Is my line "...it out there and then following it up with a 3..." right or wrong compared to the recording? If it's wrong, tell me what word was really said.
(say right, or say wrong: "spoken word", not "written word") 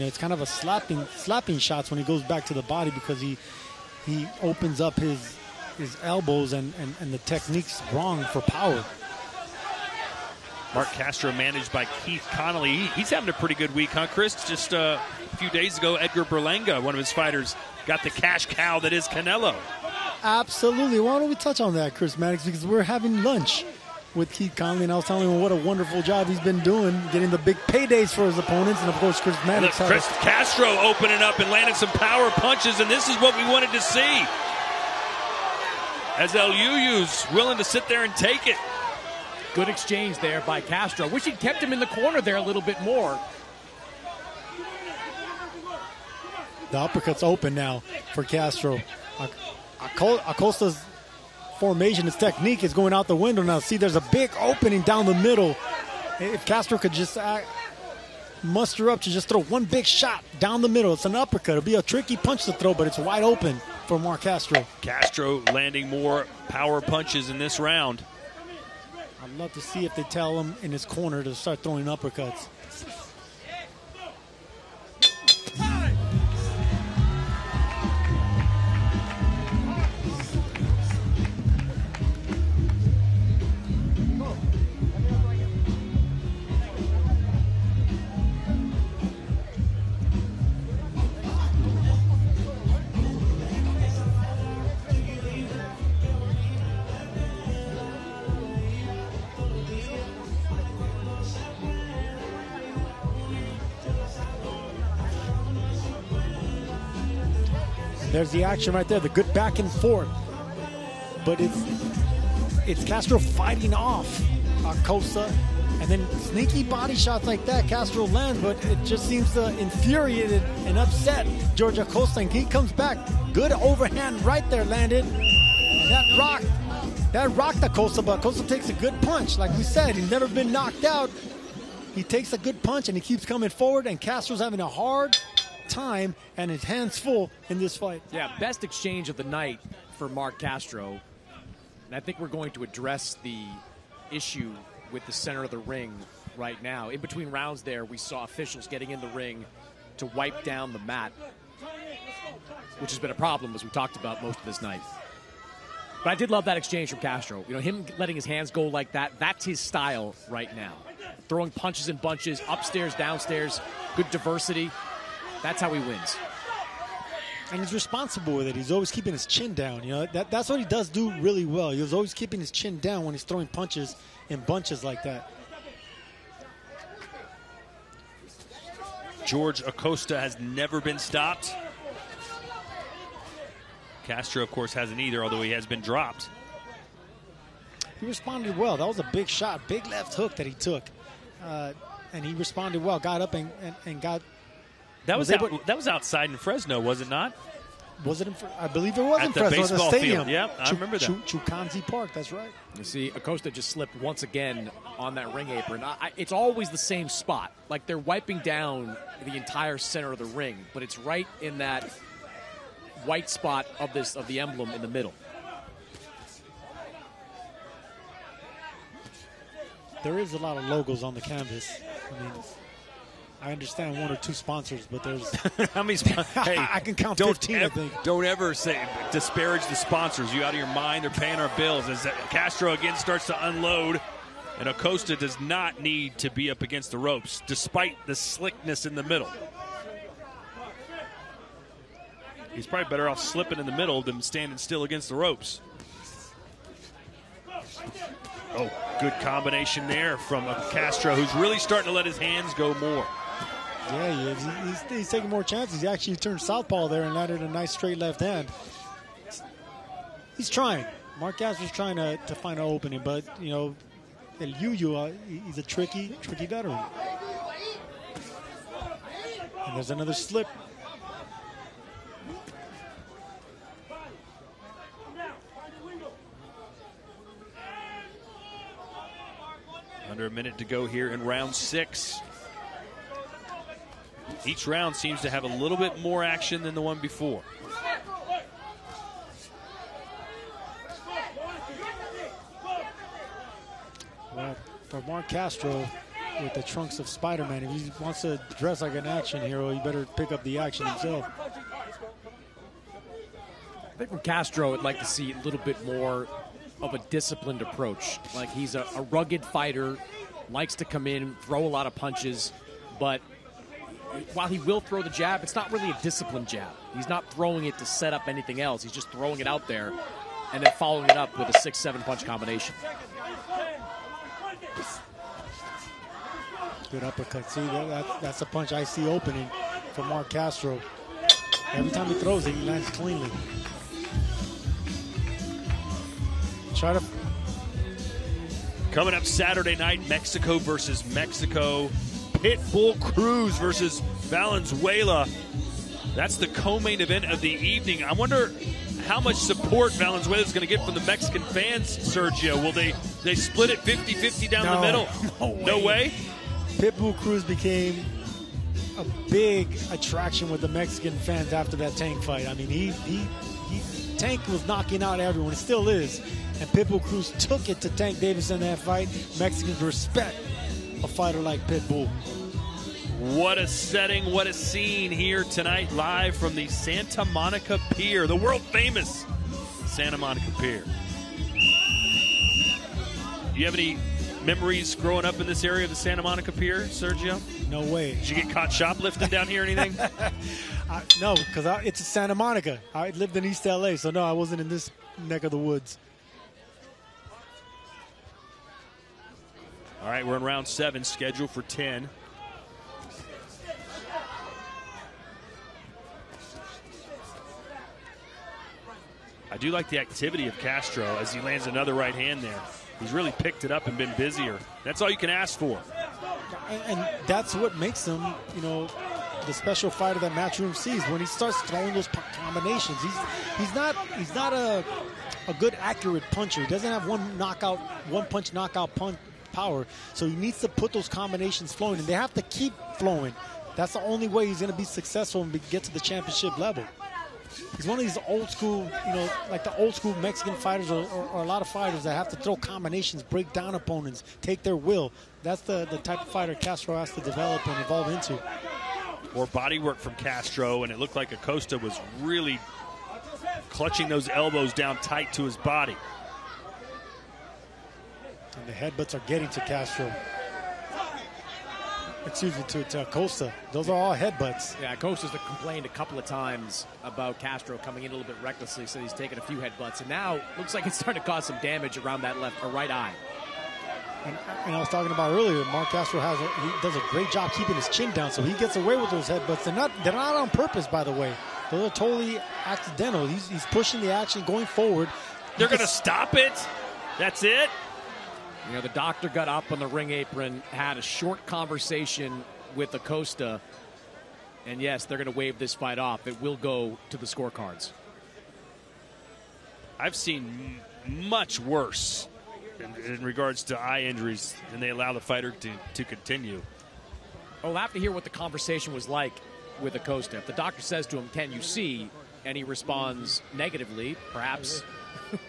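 wrong: "6", not "3".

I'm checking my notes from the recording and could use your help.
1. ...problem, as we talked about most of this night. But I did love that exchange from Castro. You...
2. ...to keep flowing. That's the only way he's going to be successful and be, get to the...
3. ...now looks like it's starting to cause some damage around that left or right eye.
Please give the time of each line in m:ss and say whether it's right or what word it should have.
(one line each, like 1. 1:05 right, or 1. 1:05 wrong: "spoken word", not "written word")
1. 2:33 right
2. 7:12 right
3. 7:50 right.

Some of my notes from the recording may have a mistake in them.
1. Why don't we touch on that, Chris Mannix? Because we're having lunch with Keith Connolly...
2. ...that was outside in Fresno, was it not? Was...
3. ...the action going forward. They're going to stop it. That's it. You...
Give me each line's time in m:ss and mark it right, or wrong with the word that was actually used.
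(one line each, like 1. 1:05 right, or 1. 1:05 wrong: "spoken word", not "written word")
1. 0:20 right
2. 3:15 right
3. 8:04 right.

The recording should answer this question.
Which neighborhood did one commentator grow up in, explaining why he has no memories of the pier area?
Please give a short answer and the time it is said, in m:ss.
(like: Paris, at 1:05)
East LA, at 6:33.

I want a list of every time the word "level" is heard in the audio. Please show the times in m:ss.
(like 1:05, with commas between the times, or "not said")
7:16.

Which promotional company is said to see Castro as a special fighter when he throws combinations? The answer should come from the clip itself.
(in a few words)
Matchroom.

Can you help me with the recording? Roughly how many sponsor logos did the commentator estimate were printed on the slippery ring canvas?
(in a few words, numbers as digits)
15.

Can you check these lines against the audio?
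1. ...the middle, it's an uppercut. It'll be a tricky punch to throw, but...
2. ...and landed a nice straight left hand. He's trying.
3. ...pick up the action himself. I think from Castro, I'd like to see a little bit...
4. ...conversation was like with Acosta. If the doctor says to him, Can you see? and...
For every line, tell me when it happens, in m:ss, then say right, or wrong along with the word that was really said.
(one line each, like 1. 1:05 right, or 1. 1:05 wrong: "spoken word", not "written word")
1. 1:00 right
2. 4:17 right
3. 5:00 right
4. 8:28 right.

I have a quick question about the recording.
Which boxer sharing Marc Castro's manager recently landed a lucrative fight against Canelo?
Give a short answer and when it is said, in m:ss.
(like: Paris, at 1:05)
Edgar Berlanga, at 0:15.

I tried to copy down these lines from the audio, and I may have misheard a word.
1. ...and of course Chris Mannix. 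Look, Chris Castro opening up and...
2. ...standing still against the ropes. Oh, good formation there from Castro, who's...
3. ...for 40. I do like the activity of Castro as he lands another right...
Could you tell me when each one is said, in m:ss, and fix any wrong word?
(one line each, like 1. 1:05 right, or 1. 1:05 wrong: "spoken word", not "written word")
1. 0:28 right
2. 4:04 wrong: "combination", not "formation"
3. 6:41 wrong: "10", not "40".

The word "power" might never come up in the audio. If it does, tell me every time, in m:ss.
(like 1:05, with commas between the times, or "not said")
0:08, 0:31, 1:06, 7:09.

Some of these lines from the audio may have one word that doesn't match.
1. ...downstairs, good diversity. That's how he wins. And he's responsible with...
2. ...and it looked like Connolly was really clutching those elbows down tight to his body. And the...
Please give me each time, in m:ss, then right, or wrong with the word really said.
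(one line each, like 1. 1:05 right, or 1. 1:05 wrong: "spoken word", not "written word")
1. 2:42 right
2. 7:30 wrong: "Acosta", not "Connolly".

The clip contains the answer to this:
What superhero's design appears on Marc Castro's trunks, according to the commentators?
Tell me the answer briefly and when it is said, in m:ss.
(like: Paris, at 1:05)
Spider-Man, at 4:57.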